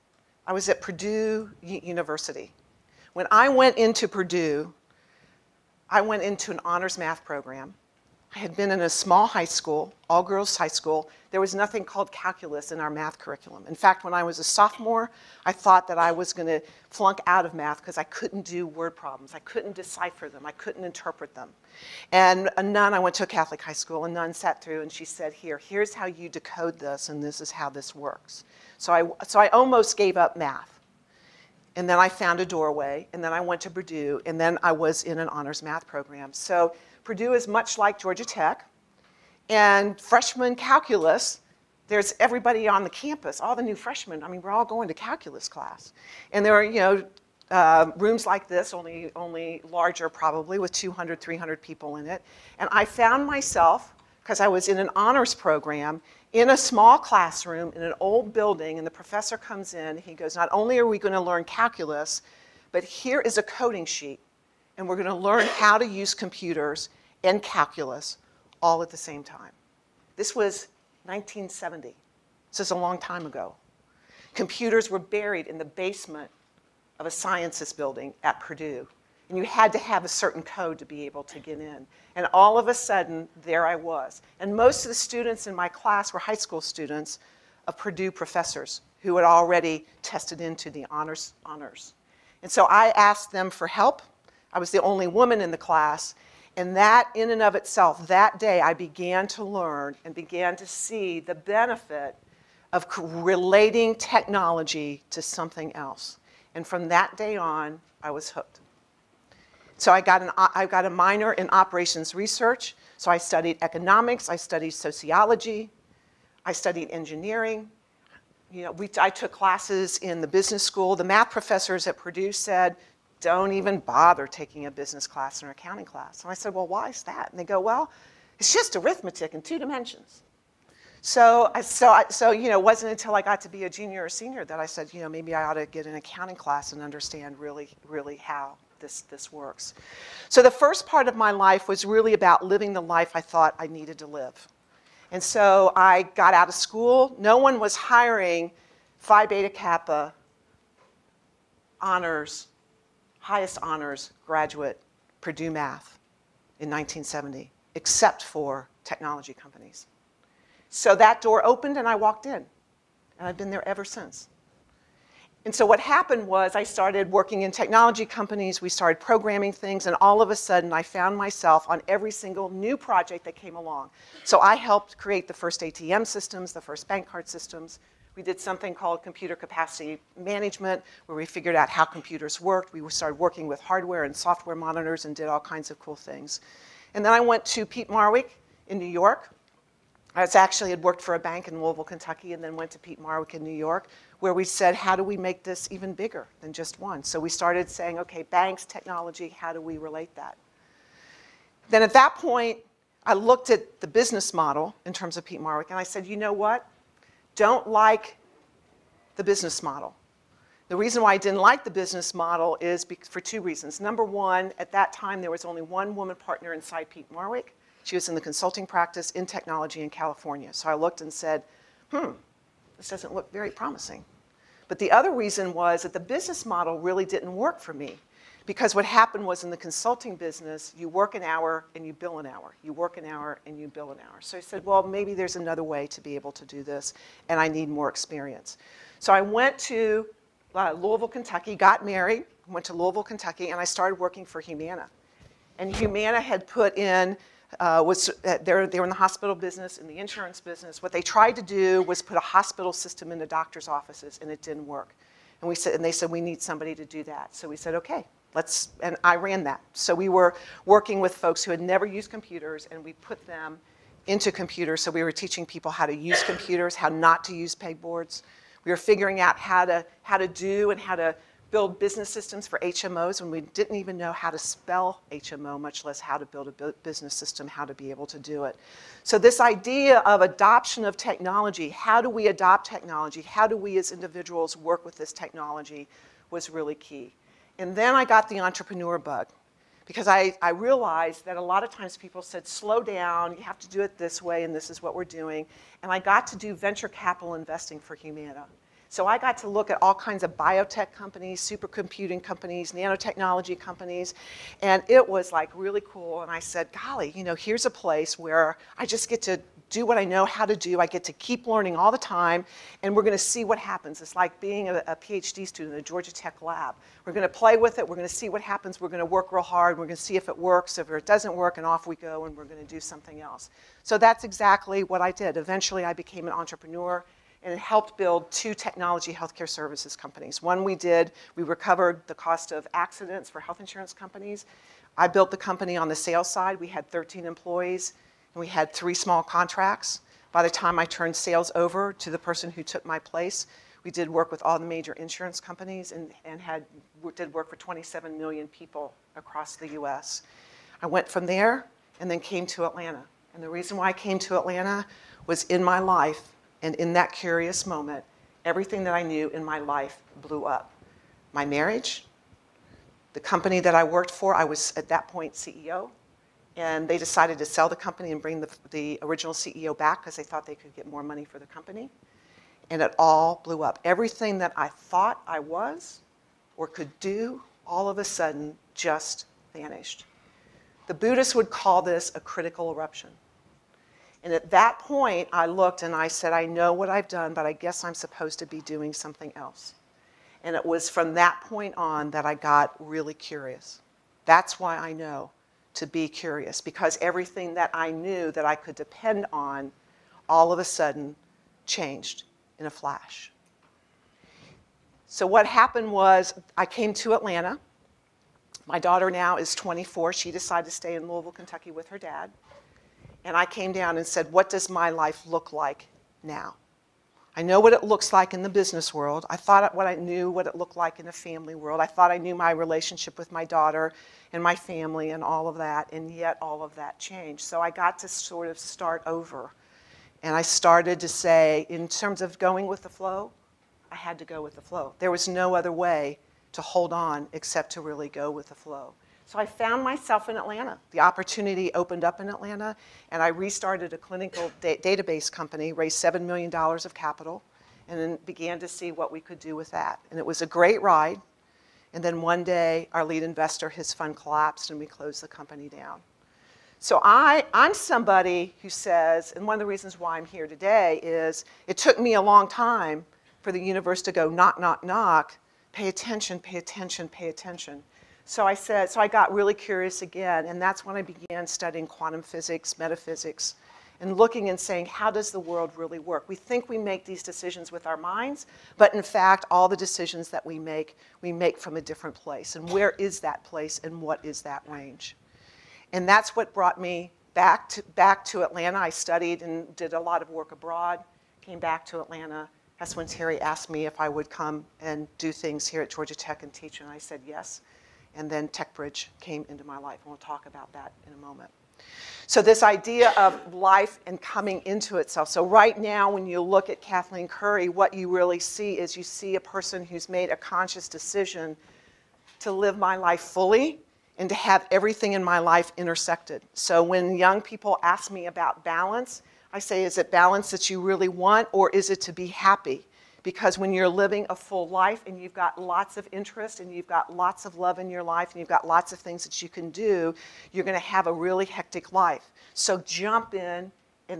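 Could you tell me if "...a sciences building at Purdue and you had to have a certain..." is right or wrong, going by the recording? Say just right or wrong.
right.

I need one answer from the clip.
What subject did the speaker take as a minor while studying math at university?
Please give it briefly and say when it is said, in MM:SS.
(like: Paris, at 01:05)
operations research, at 01:51.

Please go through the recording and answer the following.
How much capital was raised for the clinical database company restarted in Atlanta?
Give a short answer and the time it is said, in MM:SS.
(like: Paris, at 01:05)
$7 million, at 07:26.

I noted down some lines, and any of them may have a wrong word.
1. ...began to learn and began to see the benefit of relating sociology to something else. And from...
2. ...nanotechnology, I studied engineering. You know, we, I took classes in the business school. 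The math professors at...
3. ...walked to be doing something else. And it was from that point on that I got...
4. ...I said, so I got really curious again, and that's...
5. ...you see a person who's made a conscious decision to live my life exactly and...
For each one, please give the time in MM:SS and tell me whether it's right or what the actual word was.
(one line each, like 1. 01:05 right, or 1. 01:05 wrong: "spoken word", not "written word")
1. 01:38 wrong: "technology", not "sociology"
2. 01:54 wrong: "sociology", not "nanotechnology"
3. 06:27 wrong: "supposed", not "walked"
4. 07:48 right
5. 08:28 wrong: "fully", not "exactly".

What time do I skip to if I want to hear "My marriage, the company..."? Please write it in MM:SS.
06:01.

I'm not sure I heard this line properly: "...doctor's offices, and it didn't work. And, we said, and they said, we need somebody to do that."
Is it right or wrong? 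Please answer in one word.
right.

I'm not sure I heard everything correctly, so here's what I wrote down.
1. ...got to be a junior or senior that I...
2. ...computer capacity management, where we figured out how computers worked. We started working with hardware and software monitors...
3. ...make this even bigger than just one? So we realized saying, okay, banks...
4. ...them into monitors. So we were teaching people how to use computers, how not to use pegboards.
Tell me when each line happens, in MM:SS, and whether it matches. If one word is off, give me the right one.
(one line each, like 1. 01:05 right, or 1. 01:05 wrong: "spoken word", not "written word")
1. 02:13 right
2. 02:59 right
3. 03:15 wrong: "started", not "realized"
4. 04:23 wrong: "computers", not "monitors".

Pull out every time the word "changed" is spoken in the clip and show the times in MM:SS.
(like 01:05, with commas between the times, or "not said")
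06:41, 07:06.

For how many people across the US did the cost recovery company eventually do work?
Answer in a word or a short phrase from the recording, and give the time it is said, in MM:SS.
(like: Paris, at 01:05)
27 million, at 05:47.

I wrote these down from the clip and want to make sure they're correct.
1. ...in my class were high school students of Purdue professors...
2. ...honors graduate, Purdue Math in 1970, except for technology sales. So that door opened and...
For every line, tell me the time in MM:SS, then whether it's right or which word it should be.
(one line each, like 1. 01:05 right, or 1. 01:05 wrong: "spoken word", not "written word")
1. 01:25 right
2. 02:33 wrong: "companies", not "sales".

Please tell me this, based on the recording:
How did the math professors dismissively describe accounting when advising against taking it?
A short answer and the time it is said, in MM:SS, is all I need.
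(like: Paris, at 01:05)
arithmetic in two dimensions, at 02:08.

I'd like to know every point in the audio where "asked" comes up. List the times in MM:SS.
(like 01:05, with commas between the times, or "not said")
01:32, 08:13.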